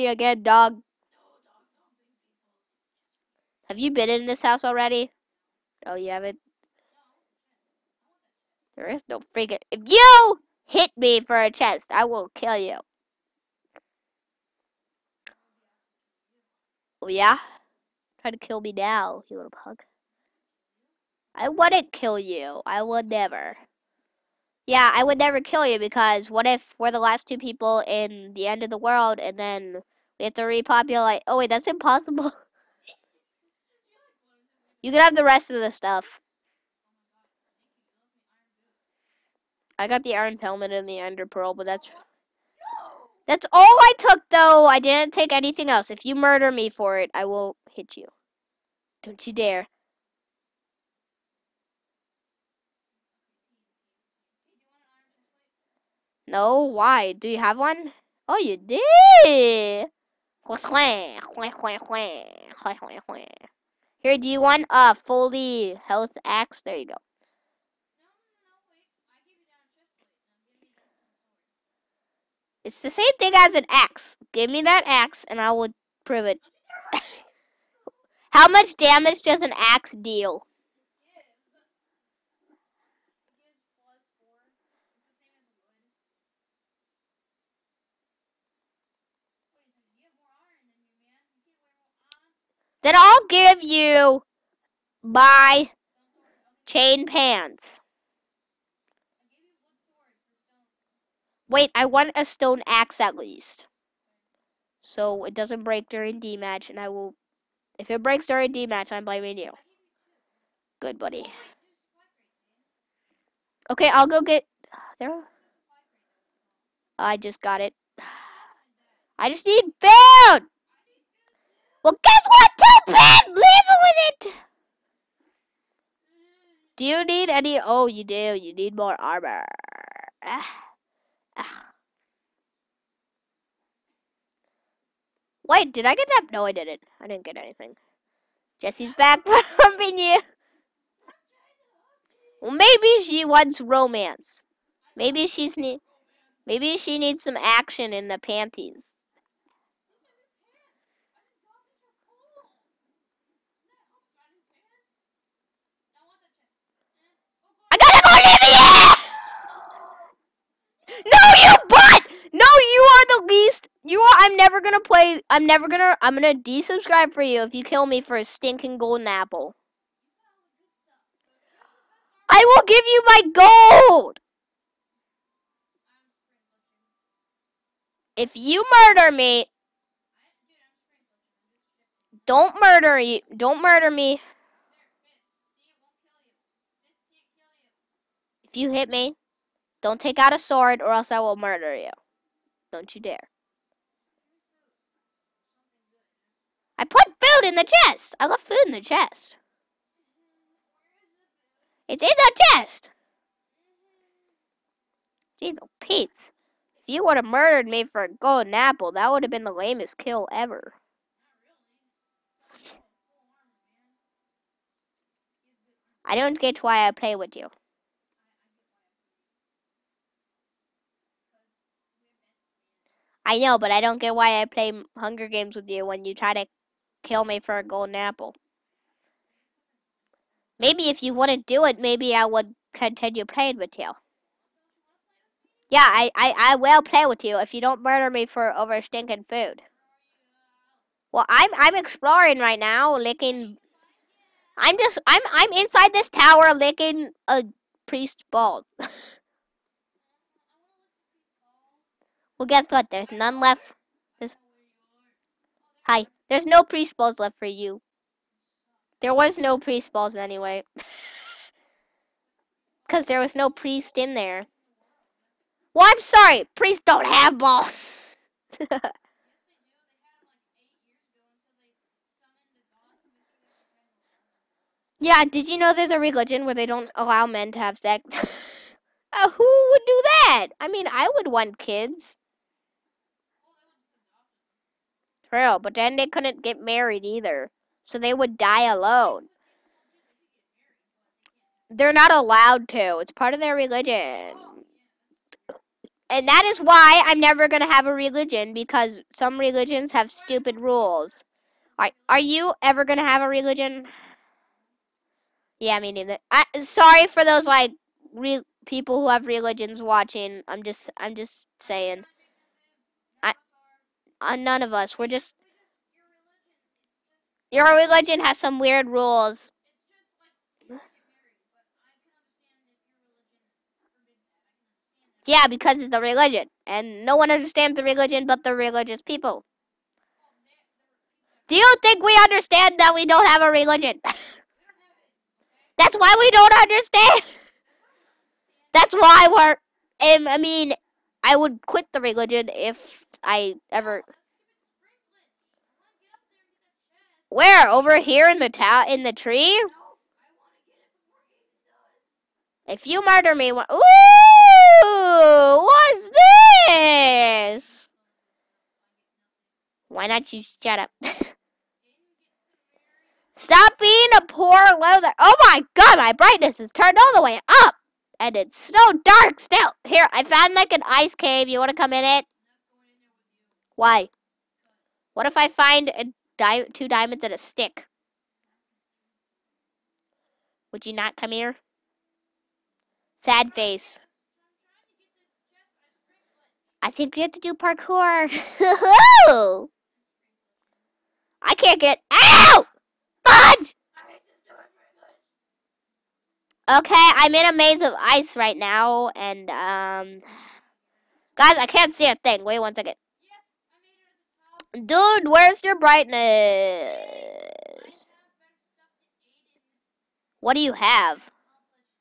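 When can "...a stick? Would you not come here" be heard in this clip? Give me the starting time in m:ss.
6:17.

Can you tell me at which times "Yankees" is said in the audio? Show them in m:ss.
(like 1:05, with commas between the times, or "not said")
not said.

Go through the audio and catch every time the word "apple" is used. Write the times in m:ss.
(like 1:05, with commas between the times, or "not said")
2:49, 3:28, 3:47.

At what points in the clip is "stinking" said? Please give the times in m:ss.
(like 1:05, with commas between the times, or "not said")
2:48, 3:58.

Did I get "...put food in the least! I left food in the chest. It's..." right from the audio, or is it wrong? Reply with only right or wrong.
wrong.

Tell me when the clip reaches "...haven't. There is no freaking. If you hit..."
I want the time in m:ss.
0:06.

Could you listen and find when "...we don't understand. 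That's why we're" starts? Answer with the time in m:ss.
5:36.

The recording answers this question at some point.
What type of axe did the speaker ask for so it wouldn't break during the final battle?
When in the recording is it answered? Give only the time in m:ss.
1:42.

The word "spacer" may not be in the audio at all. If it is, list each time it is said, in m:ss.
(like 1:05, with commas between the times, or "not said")
not said.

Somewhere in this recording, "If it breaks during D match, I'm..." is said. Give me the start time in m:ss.
1:47.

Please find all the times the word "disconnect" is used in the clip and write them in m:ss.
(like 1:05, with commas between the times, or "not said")
not said.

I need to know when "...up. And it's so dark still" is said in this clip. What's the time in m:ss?
6:07.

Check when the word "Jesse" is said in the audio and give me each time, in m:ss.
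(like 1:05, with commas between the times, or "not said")
2:18.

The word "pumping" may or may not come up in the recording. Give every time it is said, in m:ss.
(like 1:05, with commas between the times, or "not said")
2:19.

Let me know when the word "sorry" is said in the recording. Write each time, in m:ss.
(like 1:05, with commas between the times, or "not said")
4:25, 5:06.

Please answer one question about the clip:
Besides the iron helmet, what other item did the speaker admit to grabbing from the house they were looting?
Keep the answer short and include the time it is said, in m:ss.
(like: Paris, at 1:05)
Ender pearl, at 0:40.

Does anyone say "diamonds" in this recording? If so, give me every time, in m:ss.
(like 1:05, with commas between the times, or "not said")
6:16.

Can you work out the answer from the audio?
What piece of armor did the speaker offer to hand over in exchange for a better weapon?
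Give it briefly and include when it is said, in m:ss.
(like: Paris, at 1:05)
Chain pants, at 1:36.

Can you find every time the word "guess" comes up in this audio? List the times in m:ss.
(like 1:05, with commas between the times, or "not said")
2:02, 4:12.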